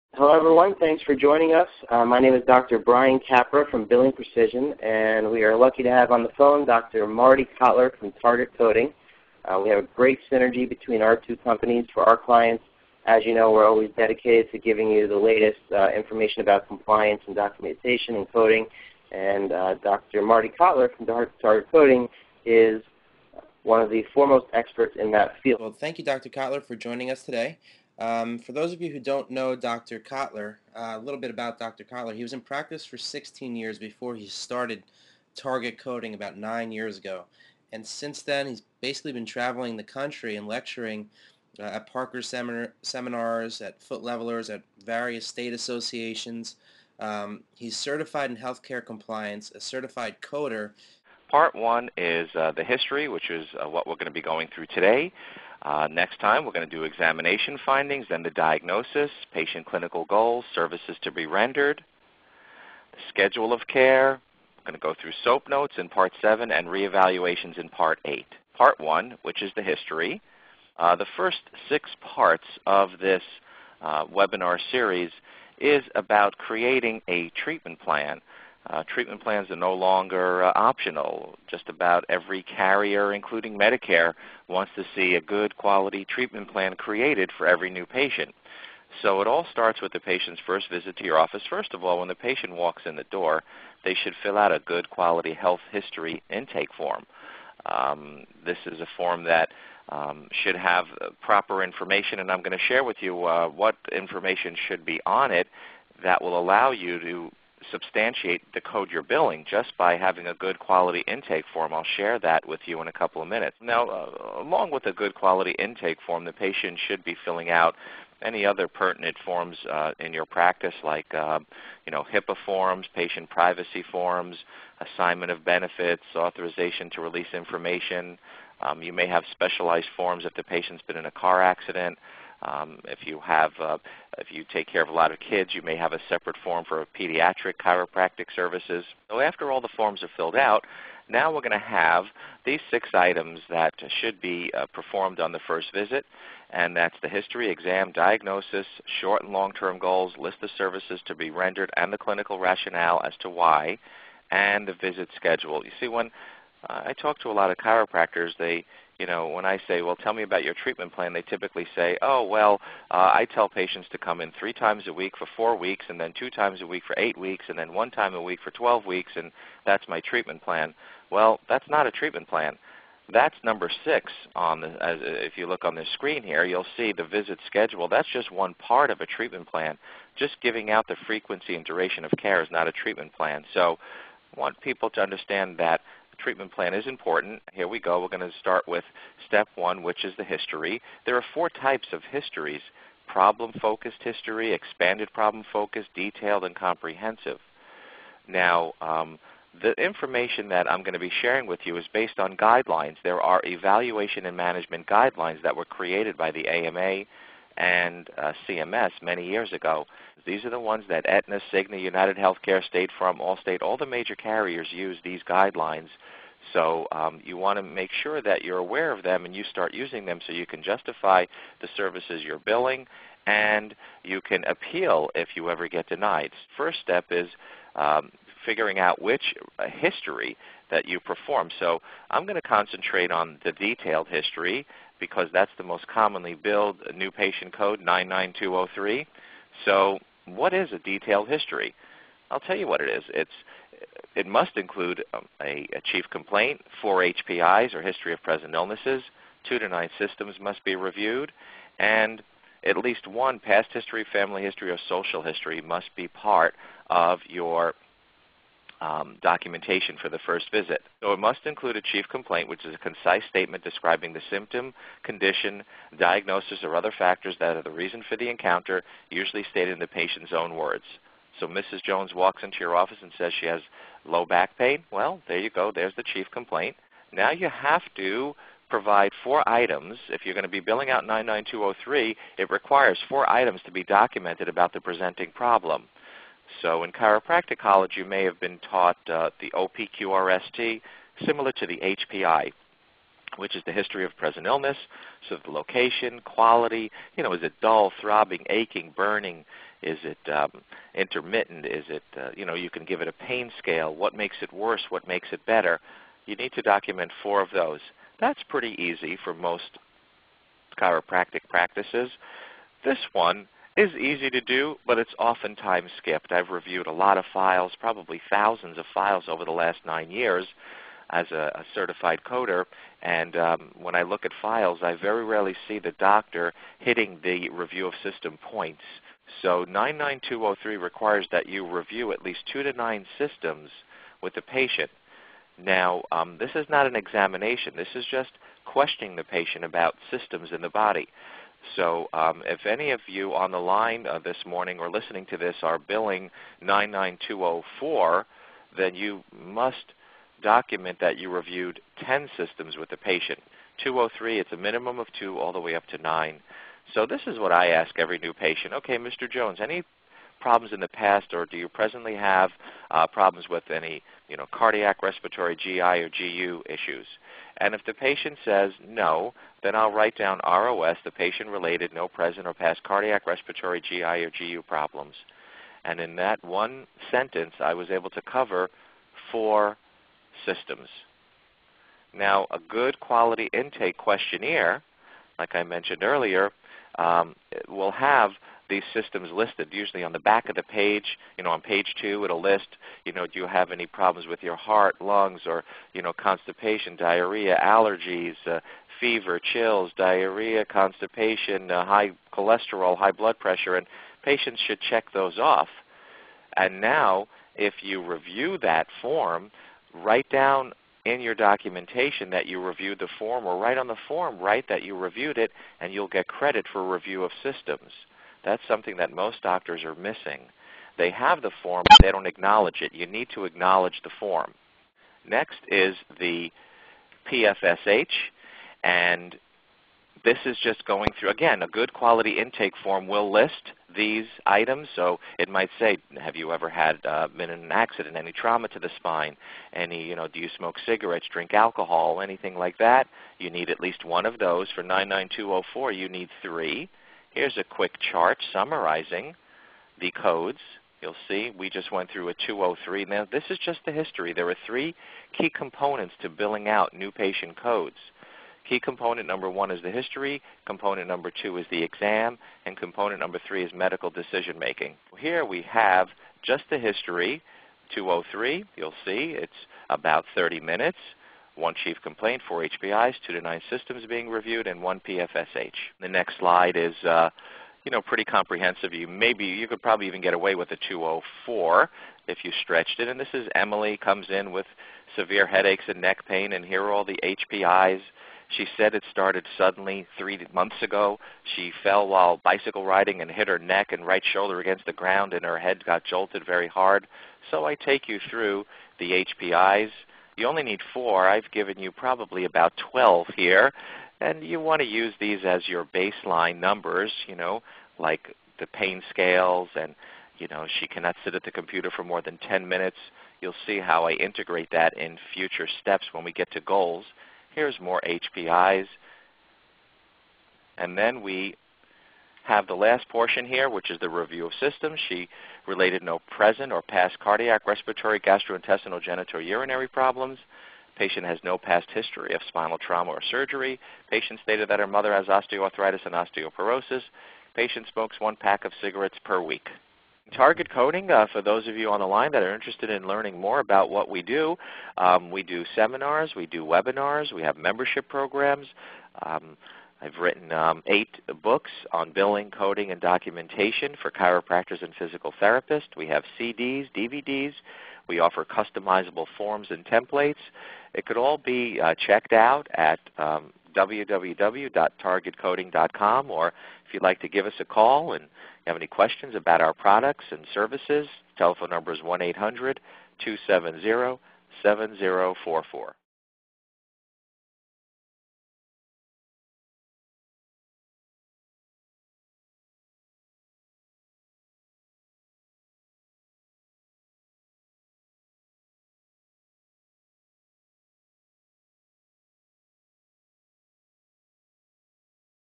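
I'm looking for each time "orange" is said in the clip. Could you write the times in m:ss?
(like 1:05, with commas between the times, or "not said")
not said.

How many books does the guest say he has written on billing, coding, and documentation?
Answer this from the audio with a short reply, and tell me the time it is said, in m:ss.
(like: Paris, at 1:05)
8, at 9:10.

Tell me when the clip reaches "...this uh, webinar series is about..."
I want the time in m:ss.
1:12.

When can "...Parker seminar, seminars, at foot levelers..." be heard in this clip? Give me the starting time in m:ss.
0:41.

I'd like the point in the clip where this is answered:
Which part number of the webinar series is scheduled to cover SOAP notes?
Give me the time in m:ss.
1:05.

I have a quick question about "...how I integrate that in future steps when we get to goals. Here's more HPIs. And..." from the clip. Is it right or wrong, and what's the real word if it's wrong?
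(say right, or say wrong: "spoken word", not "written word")
right.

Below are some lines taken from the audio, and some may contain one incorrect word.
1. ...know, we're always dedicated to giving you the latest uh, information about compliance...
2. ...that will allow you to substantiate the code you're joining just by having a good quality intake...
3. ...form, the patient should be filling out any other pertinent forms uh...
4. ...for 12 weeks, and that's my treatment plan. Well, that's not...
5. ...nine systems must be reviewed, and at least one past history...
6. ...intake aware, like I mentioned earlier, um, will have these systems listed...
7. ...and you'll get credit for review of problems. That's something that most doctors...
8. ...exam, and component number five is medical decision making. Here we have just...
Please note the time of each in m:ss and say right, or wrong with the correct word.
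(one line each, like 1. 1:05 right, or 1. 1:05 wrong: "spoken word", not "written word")
1. 0:13 right
2. 1:46 wrong: "billing", not "joining"
3. 1:56 right
4. 2:48 right
5. 4:09 right
6. 6:23 wrong: "questionnaire", not "aware"
7. 6:55 wrong: "systems", not "problems"
8. 7:41 wrong: "three", not "five".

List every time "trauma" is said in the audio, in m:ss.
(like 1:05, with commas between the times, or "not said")
7:18, 8:52.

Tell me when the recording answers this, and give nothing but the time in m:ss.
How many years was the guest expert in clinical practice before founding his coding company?
0:32.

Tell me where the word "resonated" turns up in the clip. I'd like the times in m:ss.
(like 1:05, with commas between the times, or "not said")
not said.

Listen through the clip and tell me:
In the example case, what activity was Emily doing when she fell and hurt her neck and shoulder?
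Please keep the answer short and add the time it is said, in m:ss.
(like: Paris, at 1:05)
bicycle riding, at 8:12.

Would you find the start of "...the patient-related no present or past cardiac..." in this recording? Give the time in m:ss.
6:11.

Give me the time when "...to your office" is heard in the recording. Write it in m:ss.
1:30.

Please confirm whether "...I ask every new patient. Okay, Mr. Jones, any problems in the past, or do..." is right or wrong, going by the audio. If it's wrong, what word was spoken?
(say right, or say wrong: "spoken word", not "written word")
right.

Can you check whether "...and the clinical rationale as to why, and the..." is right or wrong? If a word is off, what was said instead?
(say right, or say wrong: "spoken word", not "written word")
right.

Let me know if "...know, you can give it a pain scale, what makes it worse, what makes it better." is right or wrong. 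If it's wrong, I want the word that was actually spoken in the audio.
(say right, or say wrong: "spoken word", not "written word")
right.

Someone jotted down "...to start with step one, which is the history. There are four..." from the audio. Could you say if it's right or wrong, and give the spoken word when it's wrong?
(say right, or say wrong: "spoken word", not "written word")
right.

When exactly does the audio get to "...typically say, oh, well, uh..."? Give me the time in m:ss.
2:41.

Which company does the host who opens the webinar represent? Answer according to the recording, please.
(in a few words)
Billing Precision.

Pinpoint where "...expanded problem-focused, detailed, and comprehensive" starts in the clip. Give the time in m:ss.
3:14.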